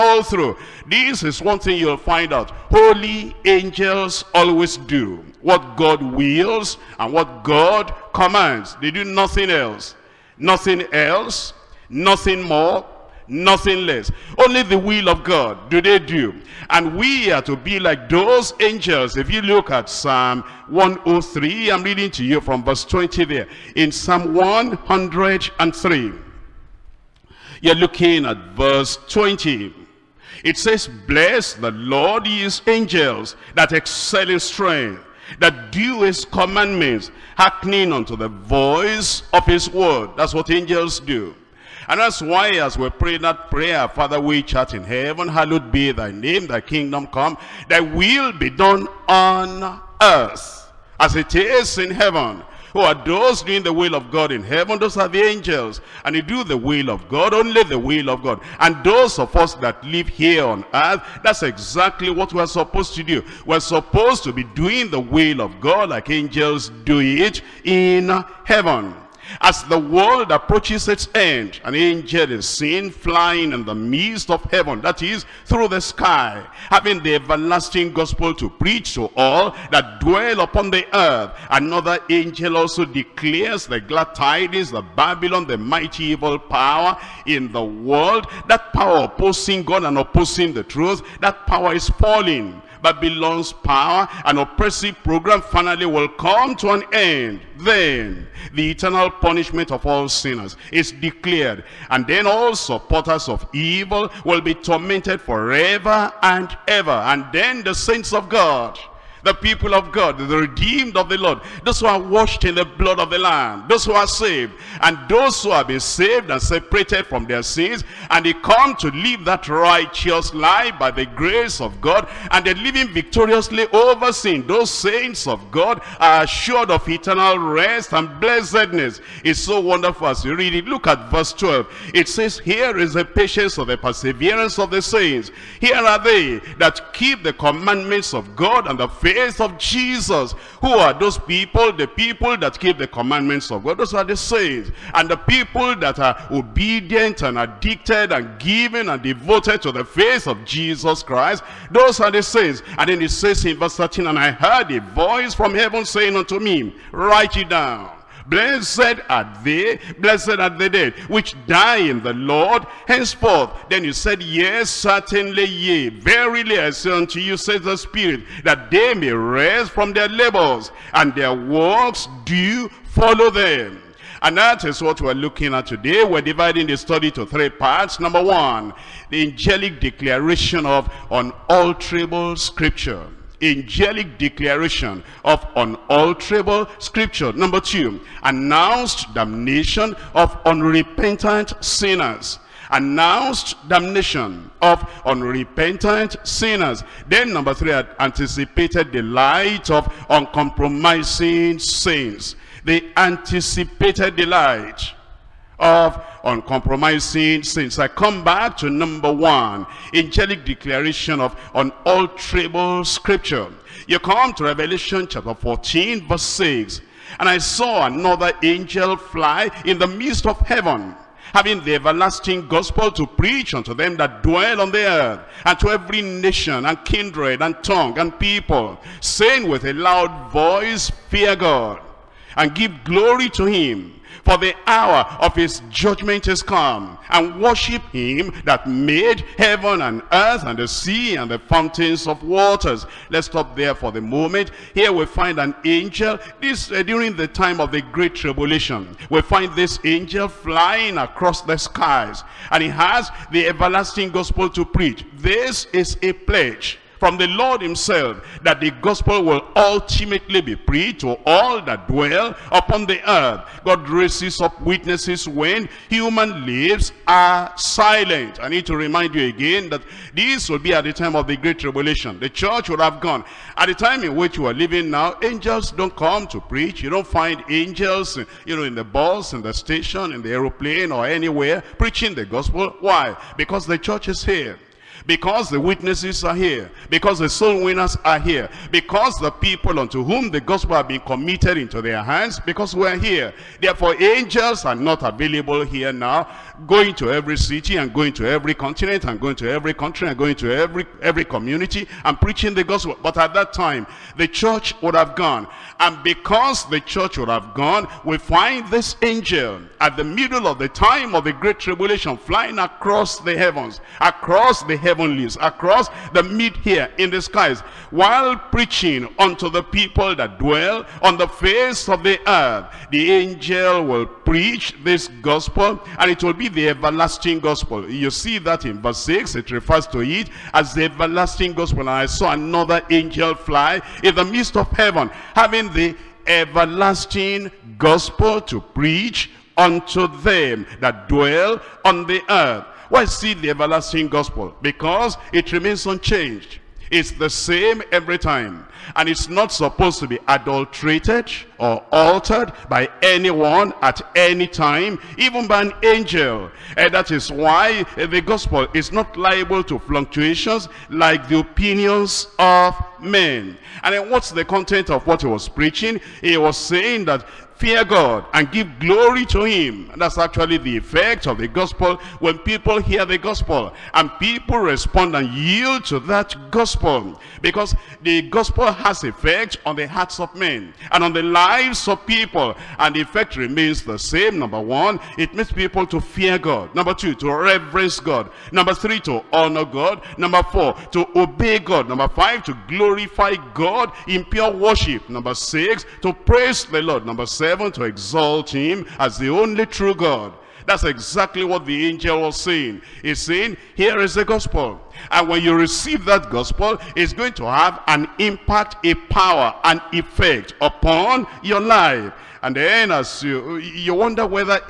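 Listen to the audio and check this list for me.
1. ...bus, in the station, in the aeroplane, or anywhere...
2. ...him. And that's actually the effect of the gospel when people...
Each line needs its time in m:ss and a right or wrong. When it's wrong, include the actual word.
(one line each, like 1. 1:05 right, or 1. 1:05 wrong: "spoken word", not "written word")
1. 4:38 right
2. 6:09 right.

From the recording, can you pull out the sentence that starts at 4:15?
This is a pledge from the Lord himself that the gospel will ultimately be preached to all that dwell upon the earth.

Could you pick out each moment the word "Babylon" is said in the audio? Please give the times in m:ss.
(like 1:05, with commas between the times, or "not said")
1:24, 1:32.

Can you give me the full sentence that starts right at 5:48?
And it's not supposed to be adulterated or altered by anyone at any time, even by an angel.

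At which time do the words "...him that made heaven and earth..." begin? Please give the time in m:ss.
3:57.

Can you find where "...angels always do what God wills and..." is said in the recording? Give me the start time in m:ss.
0:03.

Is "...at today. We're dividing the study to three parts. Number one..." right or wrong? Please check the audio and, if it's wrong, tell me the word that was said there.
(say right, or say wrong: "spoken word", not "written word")
right.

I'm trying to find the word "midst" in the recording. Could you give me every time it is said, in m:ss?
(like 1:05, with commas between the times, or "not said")
1:13, 3:39, 5:34.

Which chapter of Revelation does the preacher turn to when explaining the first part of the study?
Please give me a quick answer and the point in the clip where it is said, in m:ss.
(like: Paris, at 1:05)
Chapter 14, at 3:34.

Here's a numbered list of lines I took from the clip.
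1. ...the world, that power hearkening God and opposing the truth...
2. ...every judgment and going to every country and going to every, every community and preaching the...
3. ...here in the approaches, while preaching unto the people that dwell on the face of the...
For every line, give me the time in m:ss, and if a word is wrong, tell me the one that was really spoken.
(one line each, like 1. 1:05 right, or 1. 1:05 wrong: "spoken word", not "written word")
1. 1:27 wrong: "opposing", not "hearkening"
2. 4:58 wrong: "continent", not "judgment"
3. 5:16 wrong: "skies", not "approaches".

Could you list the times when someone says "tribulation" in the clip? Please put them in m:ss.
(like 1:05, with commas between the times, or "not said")
4:08, 4:31, 5:11.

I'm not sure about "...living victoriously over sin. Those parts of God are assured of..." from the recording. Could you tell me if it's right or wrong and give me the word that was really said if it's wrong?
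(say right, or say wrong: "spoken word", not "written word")
wrong: "saints", not "parts".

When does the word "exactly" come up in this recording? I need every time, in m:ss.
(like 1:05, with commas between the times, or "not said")
1:01, 6:40.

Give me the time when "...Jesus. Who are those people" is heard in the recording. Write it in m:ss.
2:19.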